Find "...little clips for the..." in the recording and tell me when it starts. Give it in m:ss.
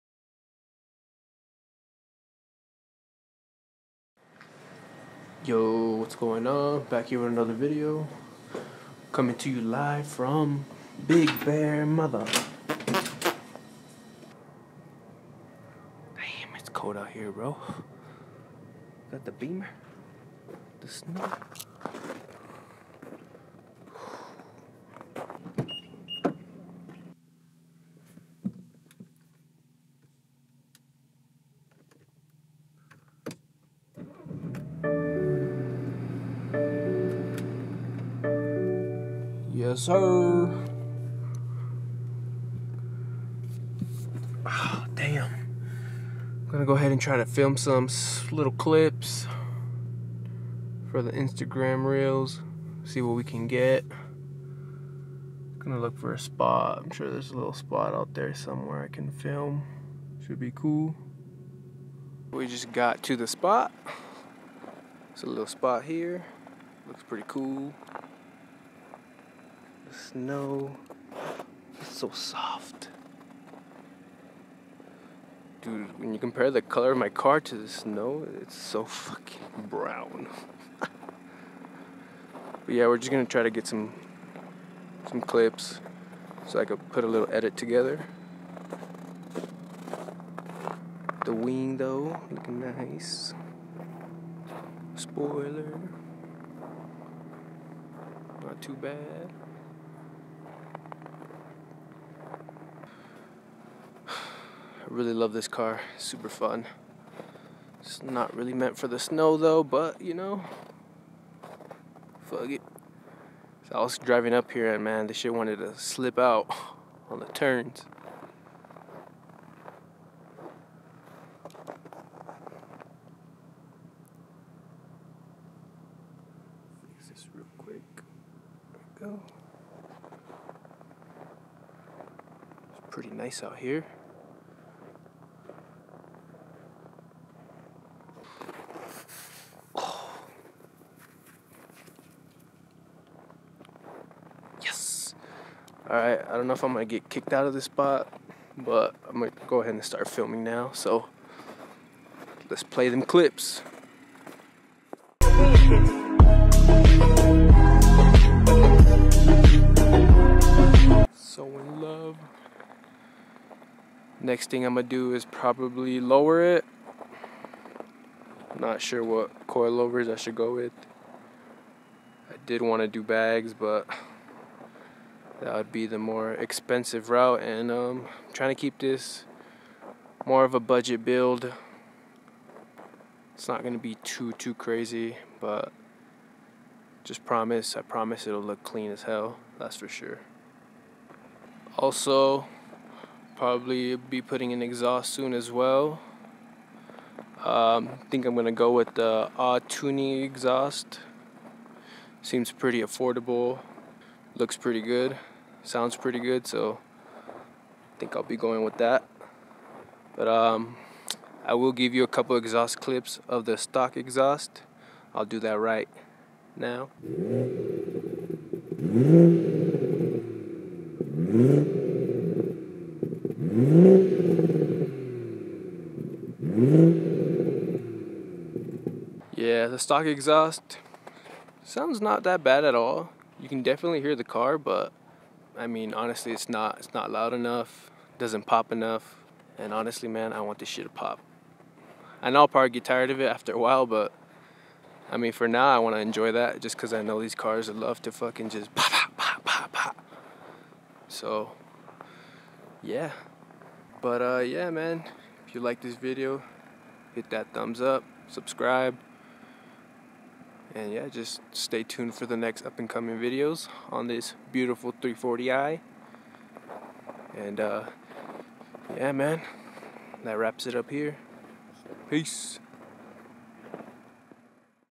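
0:48.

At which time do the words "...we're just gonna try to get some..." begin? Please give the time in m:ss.
1:22.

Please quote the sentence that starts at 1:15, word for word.
Dude, when you compare the color of my car to the snow, it's so fucking brown.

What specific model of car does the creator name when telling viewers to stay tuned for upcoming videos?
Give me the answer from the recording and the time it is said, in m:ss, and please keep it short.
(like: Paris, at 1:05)
340i, at 4:25.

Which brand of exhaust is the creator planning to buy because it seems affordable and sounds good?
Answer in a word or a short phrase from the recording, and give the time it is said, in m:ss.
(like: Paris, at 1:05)
Autuni, at 3:19.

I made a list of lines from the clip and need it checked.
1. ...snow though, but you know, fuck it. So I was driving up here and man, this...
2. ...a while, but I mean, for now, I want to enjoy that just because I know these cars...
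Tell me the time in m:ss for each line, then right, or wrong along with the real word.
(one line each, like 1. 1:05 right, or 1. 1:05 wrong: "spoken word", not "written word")
1. 1:48 right
2. 4:03 right.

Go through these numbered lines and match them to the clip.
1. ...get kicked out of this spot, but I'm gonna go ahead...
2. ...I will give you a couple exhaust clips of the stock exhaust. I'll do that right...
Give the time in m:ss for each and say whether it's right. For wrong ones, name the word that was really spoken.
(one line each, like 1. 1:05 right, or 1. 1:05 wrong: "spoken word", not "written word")
1. 2:26 right
2. 3:31 right.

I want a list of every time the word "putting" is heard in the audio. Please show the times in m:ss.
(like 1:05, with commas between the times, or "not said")
3:14.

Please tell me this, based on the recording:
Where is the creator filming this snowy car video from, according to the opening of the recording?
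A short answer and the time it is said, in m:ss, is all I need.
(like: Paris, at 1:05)
Big Bear, at 0:11.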